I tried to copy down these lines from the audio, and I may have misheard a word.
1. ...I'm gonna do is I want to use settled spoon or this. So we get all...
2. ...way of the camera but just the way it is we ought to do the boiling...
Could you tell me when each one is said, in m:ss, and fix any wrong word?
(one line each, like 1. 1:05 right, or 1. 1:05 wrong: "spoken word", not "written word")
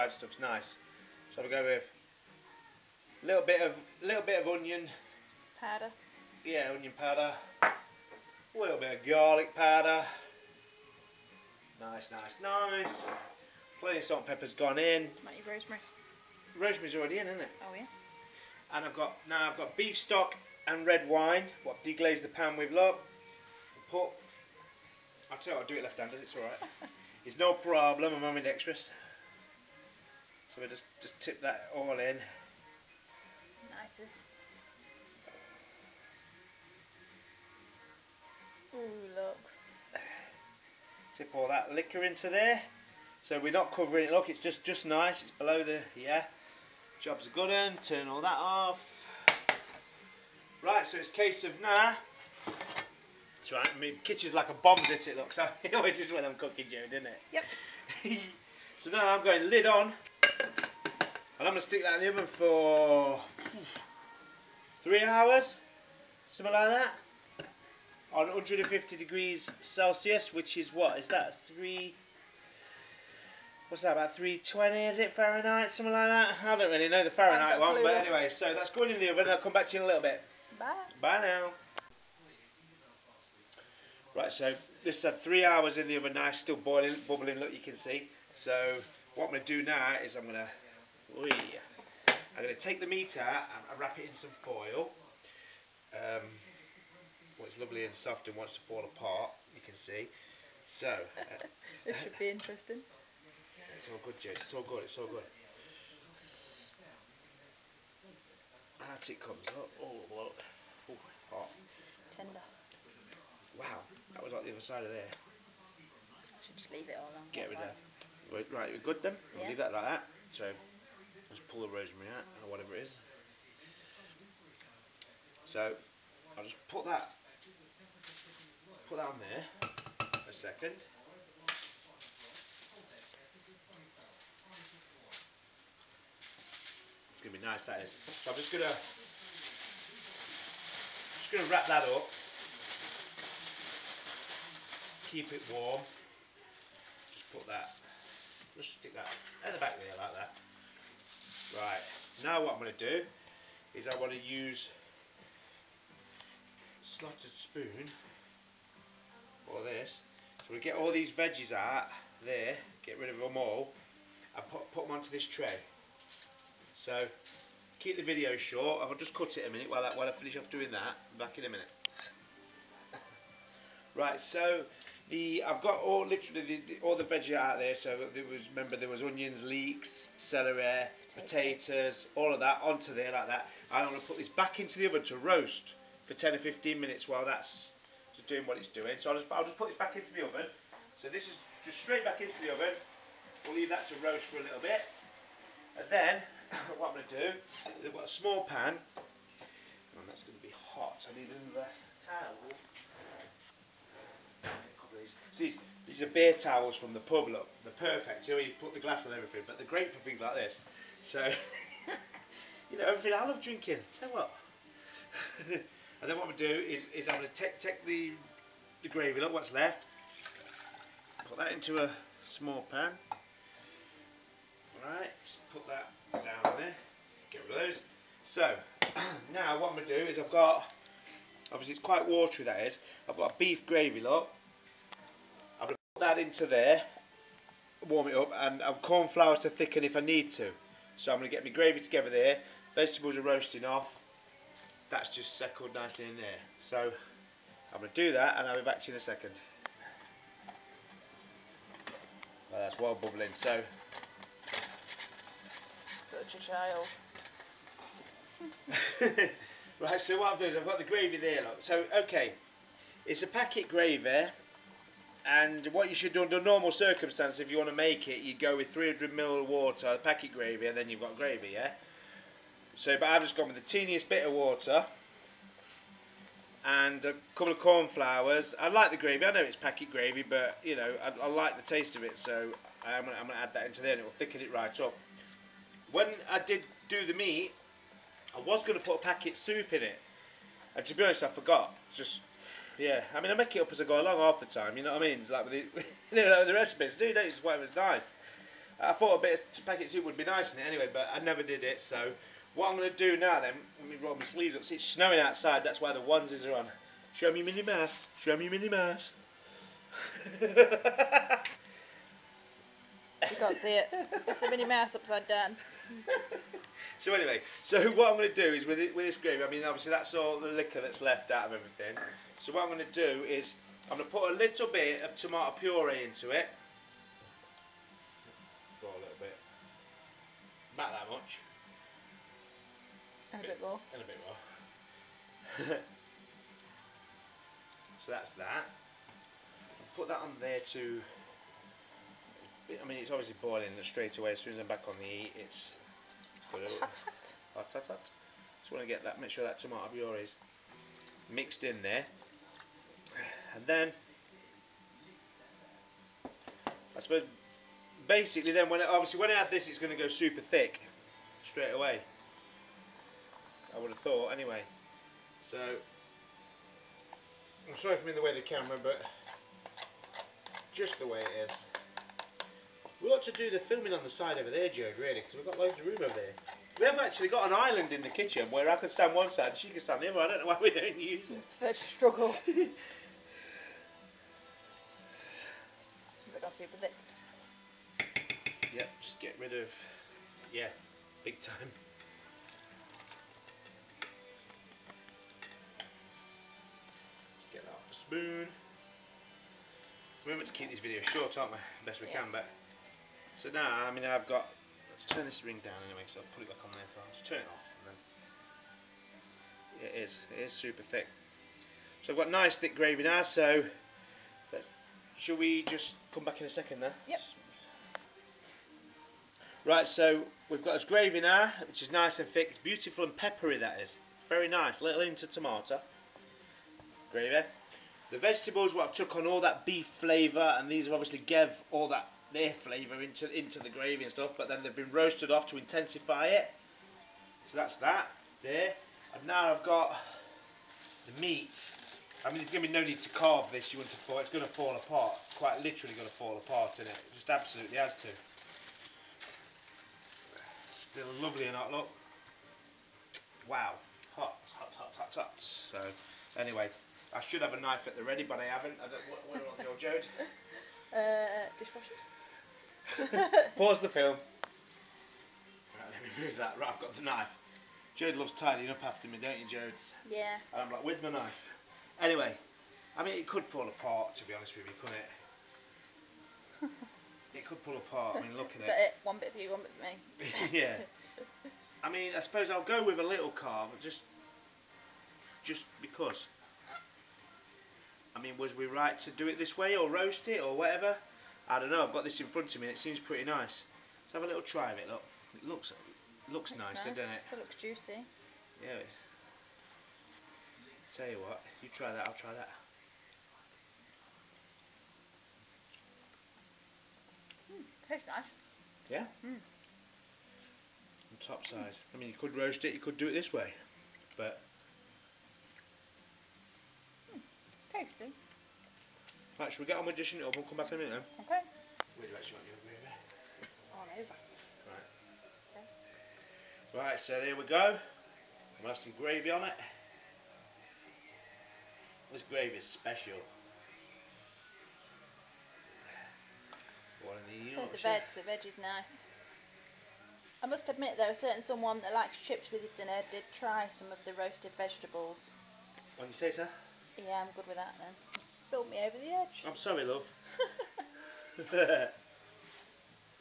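1. 2:32 wrong: "slotted", not "settled"
2. 6:08 wrong: "filming", not "boiling".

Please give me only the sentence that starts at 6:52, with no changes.
So I've got nice thick gravy now.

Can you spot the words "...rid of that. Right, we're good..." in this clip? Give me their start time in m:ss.
1:57.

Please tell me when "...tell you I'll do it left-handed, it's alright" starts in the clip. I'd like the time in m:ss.
0:25.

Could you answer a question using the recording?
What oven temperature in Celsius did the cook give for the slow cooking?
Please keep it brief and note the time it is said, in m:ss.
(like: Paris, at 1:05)
150 degrees Celsius, at 1:08.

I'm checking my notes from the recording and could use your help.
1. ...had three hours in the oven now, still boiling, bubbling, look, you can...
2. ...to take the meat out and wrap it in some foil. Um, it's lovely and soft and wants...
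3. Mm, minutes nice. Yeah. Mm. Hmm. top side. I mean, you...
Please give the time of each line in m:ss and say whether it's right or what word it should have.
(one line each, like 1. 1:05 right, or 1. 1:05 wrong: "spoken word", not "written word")
1. 1:25 right
2. 1:32 right
3. 8:27 wrong: "tastes", not "minutes".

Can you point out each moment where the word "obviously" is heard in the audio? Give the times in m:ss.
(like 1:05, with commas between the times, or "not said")
3:51, 5:19, 5:43, 5:58, 7:10.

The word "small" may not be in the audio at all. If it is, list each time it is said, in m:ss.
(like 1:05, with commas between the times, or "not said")
3:18, 3:42.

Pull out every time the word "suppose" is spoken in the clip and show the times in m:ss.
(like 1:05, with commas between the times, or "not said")
5:57, 8:02.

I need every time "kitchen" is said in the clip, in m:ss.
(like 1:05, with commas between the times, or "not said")
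0:54, 6:18.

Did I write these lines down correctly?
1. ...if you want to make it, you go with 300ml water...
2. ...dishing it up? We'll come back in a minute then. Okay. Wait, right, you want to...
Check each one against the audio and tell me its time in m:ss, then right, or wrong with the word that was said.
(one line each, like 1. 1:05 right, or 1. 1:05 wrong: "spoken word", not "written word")
1. 4:27 right
2. 8:39 right.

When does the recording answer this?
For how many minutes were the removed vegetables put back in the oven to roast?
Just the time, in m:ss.
3:06.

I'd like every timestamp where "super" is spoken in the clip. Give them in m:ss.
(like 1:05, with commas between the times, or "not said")
6:00, 6:50.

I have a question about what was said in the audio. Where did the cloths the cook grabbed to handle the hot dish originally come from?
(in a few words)
The pub.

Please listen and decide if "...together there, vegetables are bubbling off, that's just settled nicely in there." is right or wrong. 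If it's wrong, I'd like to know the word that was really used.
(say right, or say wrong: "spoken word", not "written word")
wrong: "roasting", not "bubbling".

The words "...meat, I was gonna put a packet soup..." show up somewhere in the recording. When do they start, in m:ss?
4:47.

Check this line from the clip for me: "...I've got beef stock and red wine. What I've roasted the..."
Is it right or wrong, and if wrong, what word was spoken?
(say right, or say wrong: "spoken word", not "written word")
wrong: "deglazed", not "roasted".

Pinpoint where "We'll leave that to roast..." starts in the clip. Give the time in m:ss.
3:13.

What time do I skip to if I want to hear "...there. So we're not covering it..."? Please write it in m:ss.
0:42.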